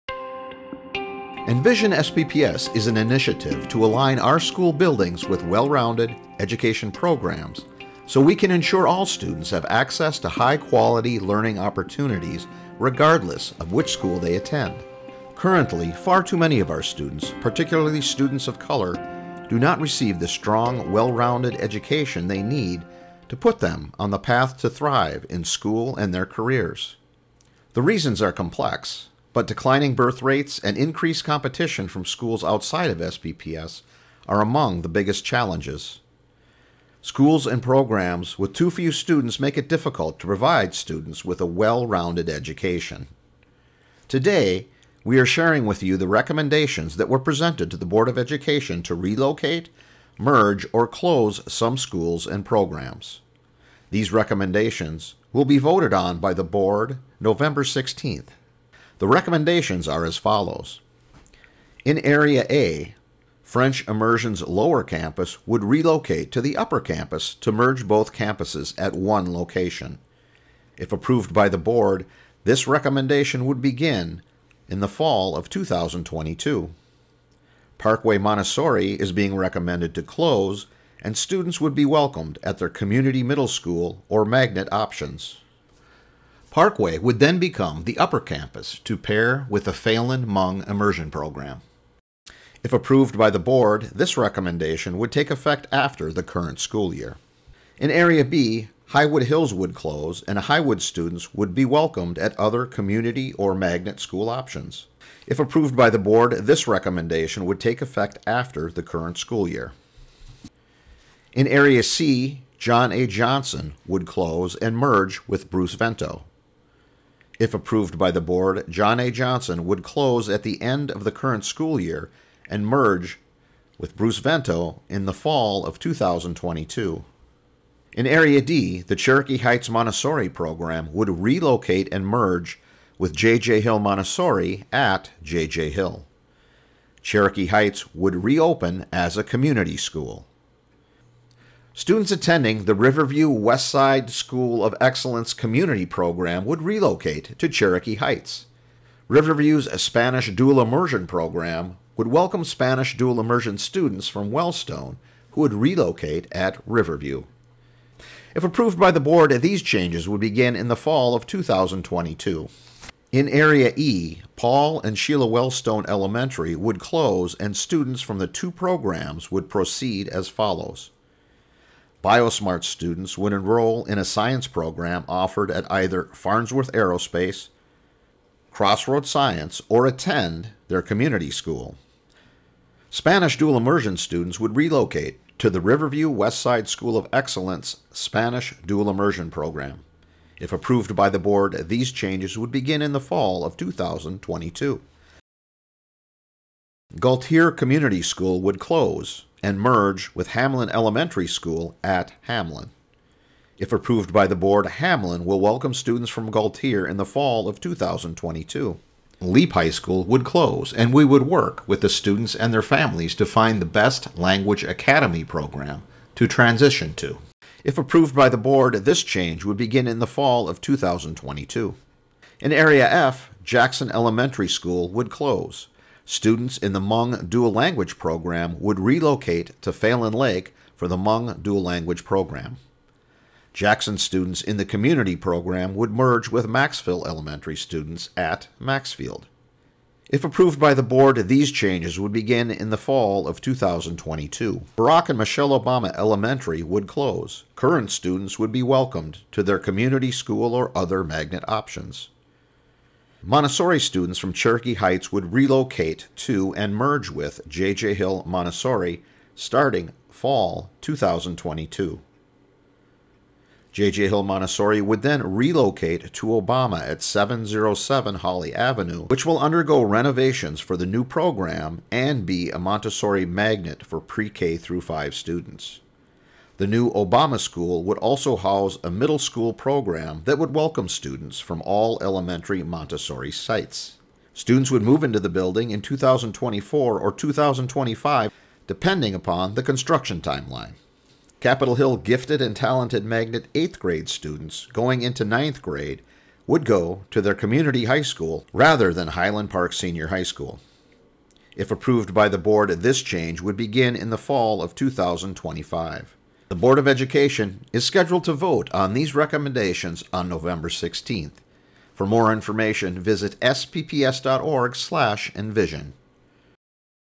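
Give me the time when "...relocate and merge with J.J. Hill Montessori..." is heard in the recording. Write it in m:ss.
2:11.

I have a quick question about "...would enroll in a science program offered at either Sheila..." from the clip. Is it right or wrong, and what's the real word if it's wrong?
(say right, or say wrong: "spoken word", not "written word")
wrong: "Farnsworth", not "Sheila".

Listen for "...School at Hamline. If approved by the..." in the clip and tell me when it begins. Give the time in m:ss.
3:21.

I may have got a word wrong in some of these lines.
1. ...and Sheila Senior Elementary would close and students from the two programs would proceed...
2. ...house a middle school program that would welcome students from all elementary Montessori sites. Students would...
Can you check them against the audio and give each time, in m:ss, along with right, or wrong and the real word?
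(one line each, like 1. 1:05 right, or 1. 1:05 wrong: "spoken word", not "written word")
1. 2:44 wrong: "Wellstone", not "Senior"
2. 4:38 right.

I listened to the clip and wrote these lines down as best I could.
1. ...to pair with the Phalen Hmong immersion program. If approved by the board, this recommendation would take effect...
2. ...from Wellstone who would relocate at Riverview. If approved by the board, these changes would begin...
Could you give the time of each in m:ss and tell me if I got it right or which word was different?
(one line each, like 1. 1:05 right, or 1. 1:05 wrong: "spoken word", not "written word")
1. 1:28 right
2. 2:34 right.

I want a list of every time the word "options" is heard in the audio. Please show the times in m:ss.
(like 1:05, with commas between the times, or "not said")
1:24, 1:44, 4:11.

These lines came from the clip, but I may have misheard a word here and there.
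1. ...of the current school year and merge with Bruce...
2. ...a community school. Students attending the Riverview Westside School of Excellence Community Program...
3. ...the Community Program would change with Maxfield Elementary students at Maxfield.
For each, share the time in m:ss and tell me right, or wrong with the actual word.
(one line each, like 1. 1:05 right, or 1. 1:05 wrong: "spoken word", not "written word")
1. 2:00 right
2. 2:19 right
3. 3:54 wrong: "merge", not "change".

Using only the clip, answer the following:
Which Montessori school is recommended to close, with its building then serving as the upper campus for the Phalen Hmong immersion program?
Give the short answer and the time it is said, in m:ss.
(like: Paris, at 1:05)
Parkway Montessori, at 1:17.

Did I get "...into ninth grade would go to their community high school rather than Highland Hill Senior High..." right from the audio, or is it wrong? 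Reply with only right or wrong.
wrong.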